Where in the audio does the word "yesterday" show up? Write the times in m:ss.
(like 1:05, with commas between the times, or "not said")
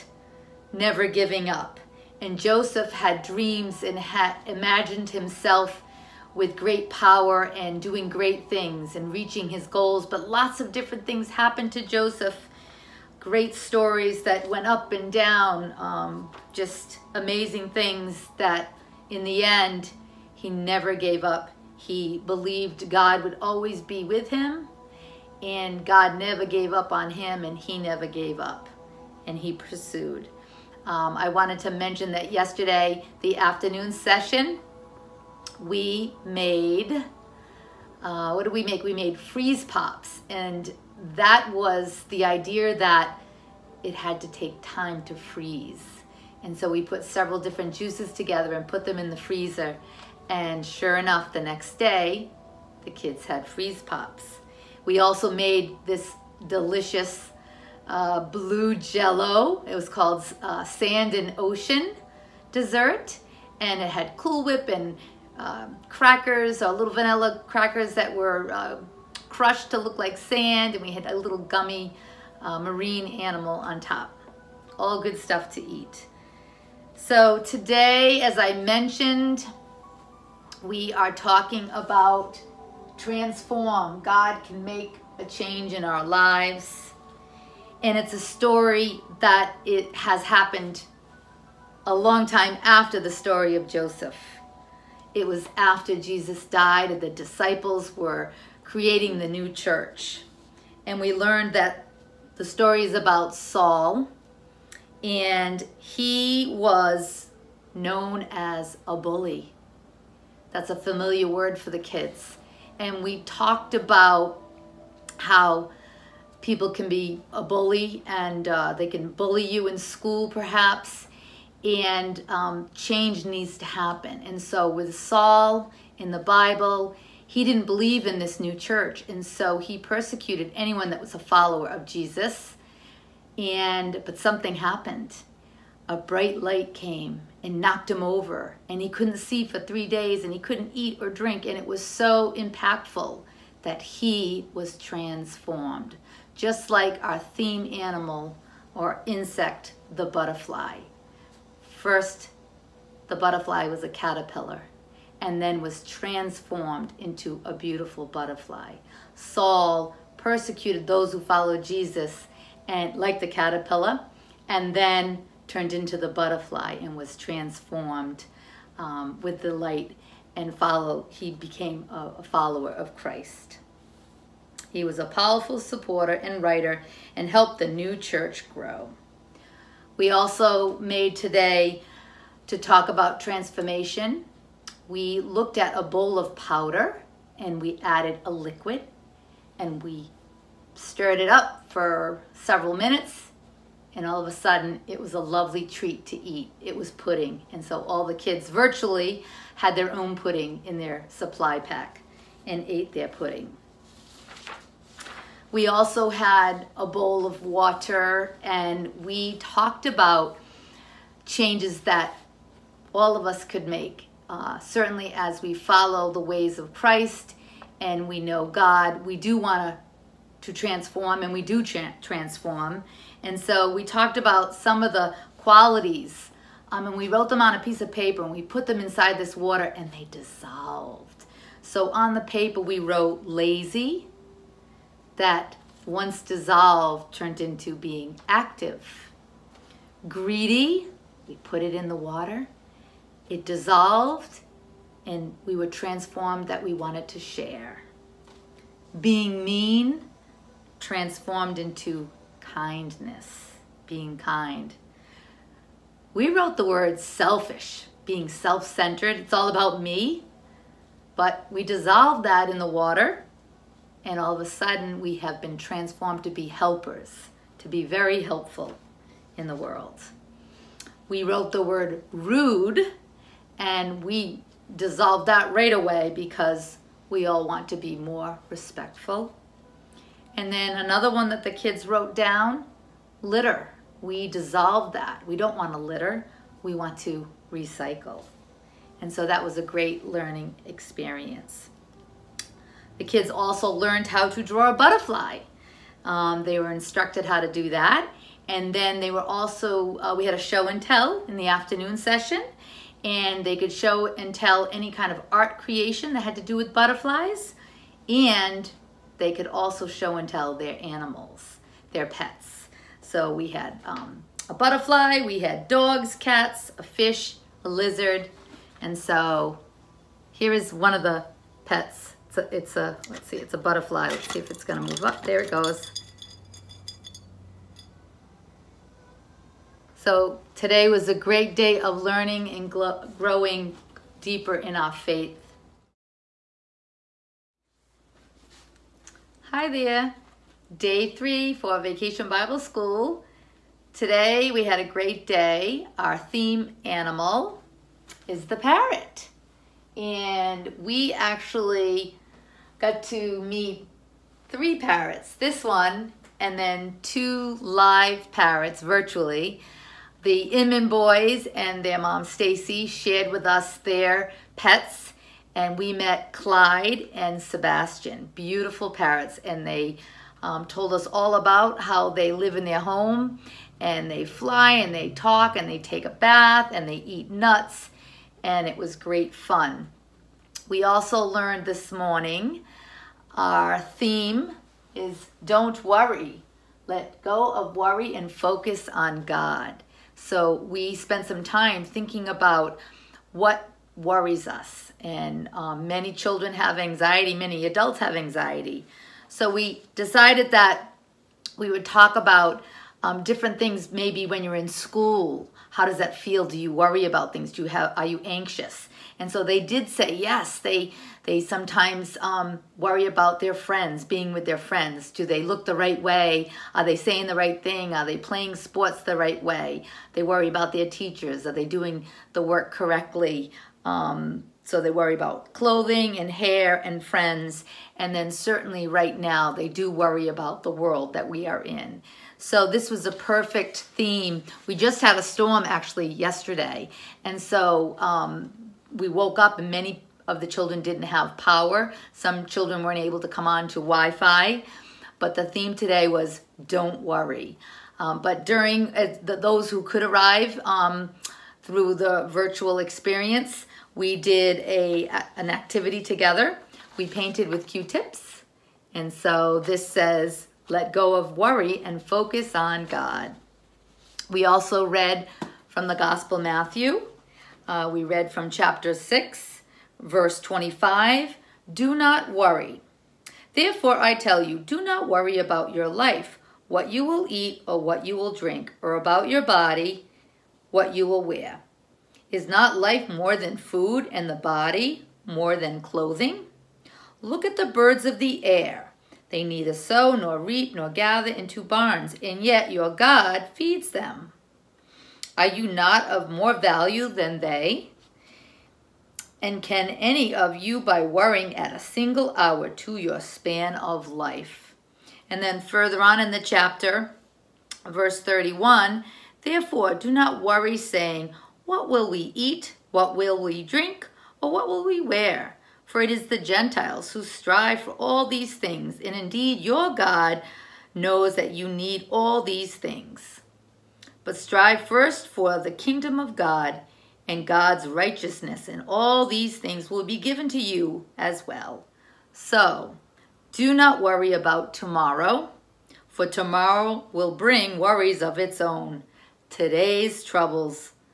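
0:32, 7:16.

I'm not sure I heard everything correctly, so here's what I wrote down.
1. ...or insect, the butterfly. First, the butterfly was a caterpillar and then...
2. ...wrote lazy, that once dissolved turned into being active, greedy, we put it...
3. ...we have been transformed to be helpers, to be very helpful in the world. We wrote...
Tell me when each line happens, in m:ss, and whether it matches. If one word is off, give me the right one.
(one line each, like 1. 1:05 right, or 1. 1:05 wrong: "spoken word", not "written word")
1. 2:28 right
2. 3:52 right
3. 4:24 right.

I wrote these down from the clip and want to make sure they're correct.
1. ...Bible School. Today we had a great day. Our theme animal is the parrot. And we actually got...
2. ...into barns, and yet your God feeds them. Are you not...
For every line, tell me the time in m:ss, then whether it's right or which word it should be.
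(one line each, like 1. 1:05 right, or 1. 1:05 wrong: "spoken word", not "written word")
1. 5:42 right
2. 8:11 right.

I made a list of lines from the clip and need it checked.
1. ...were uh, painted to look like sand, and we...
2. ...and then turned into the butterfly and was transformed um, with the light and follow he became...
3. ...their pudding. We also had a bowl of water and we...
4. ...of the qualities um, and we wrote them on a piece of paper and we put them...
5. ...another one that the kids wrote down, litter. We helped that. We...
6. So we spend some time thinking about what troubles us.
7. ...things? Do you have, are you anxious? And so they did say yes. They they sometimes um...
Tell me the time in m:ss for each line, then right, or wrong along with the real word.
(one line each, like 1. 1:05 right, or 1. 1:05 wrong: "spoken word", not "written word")
1. 1:08 wrong: "crushed", not "painted"
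2. 2:44 right
3. 3:22 right
4. 3:44 right
5. 4:40 wrong: "dissolved", not "helped"
6. 6:30 wrong: "worries", not "troubles"
7. 6:47 right.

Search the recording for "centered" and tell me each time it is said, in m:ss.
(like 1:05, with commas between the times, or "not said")
4:18.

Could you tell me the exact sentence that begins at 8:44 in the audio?
But strive first for the kingdom of God and God's righteousness, and all these things will be given to you as well.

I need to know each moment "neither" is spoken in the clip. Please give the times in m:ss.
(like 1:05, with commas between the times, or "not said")
8:09.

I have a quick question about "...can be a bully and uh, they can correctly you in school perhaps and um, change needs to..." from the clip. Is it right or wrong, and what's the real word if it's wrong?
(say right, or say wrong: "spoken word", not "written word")
wrong: "bully", not "correctly".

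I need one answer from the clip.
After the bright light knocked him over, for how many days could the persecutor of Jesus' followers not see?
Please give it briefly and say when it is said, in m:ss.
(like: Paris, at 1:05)
3, at 2:19.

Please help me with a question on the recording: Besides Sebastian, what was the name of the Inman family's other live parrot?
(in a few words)
Clyde.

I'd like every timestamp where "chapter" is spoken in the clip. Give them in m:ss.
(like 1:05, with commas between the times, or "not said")
7:48, 8:26.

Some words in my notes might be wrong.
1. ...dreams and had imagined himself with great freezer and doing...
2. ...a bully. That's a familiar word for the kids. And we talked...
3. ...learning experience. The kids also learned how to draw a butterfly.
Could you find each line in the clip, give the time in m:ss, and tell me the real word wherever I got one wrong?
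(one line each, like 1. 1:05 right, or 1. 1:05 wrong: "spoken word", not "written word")
1. 0:03 wrong: "power", not "freezer"
2. 1:48 right
3. 4:50 right.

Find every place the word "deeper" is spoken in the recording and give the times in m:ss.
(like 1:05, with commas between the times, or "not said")
5:34.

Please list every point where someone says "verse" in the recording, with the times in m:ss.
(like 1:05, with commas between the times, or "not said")
7:50, 8:27.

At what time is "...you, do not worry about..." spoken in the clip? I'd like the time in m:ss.
7:54.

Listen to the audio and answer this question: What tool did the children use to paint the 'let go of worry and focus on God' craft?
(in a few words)
Q-tips.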